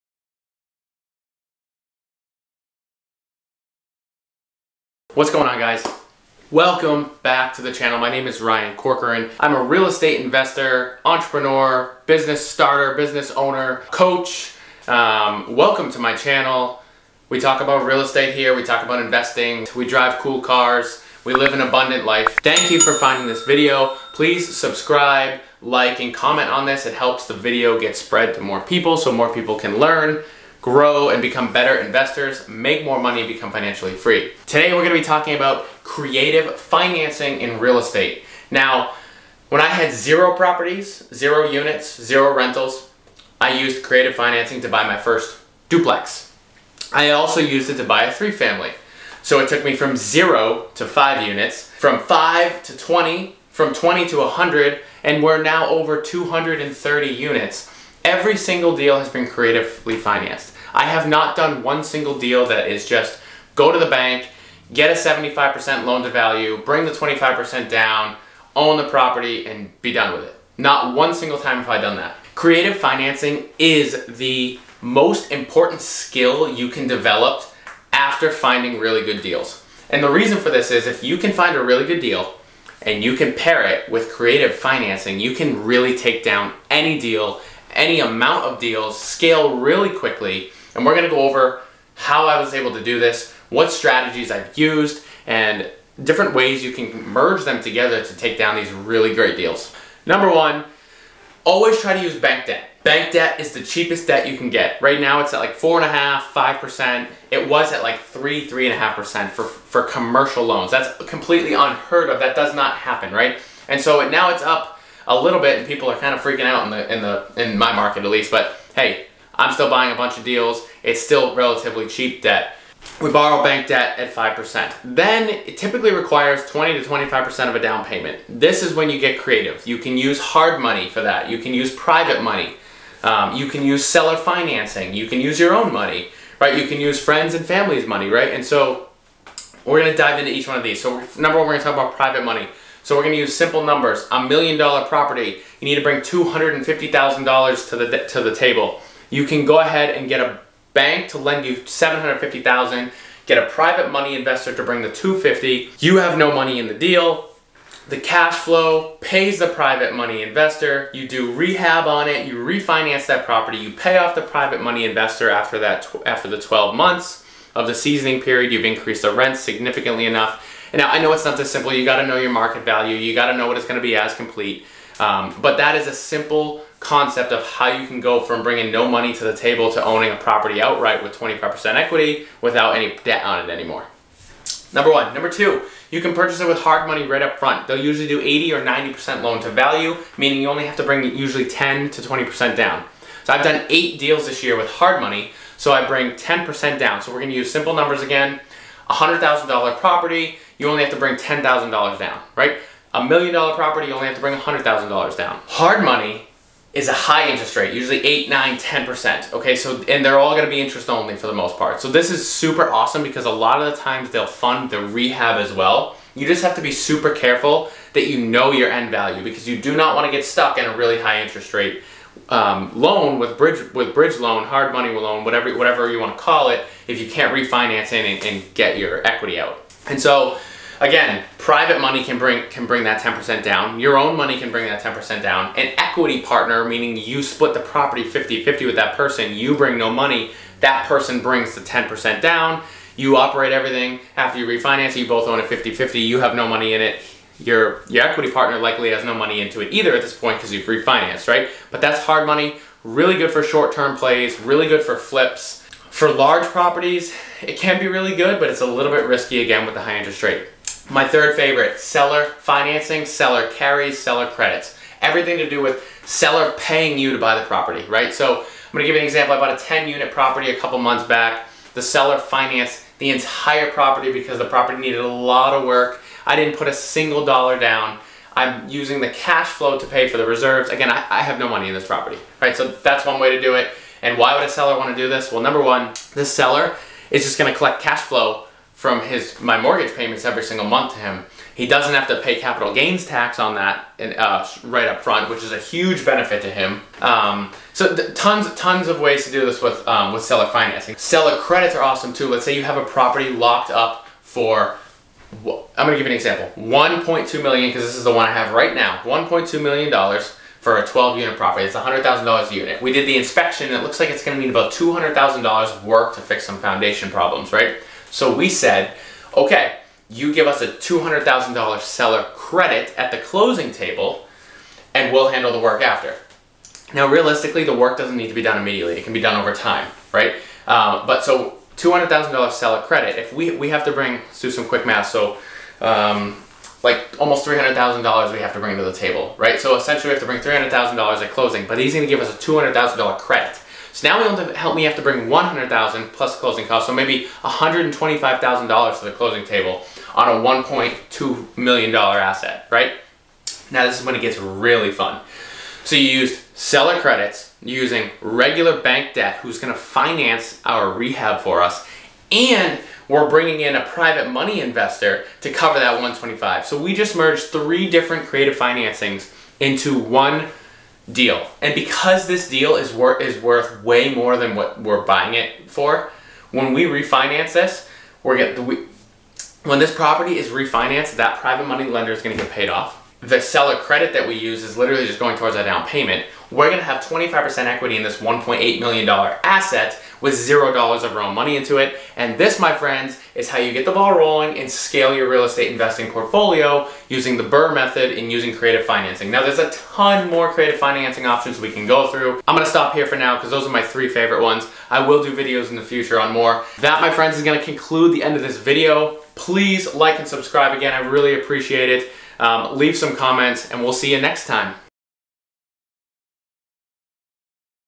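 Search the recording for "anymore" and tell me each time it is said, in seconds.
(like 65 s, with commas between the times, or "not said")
183 s.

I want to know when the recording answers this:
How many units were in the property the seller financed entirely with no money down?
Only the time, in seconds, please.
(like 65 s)
269 s.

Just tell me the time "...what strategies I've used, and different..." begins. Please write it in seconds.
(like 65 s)
93 s.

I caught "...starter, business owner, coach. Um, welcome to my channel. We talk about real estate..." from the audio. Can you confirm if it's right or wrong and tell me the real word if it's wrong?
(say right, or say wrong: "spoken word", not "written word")
right.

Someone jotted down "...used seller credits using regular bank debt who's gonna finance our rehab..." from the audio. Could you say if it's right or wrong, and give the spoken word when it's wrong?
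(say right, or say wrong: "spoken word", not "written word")
right.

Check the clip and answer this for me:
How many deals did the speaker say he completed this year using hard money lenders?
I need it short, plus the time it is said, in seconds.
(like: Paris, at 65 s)
8, at 193 s.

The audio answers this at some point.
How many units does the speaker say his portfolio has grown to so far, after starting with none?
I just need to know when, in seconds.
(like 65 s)
55 s.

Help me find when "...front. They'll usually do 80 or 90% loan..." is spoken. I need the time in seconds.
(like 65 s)
187 s.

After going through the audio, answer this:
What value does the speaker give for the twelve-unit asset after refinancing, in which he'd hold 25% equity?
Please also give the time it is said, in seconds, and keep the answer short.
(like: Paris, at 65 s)
$1.8 million, at 388 s.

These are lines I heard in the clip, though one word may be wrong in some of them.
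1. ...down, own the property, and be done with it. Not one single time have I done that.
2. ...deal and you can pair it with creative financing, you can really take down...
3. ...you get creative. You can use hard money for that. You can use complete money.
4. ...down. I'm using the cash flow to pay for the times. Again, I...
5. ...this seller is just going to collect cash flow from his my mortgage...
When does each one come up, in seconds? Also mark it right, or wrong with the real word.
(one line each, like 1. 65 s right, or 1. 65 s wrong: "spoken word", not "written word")
1. 67 s right
2. 81 s right
3. 128 s wrong: "private", not "complete"
4. 277 s wrong: "reserves", not "times"
5. 286 s right.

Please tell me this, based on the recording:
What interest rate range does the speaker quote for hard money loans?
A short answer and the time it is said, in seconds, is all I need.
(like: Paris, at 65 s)
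8, 9, 10%, at 208 s.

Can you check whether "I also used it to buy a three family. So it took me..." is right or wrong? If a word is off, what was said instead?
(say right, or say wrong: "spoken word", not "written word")
right.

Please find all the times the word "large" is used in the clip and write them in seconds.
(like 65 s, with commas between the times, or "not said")
256 s.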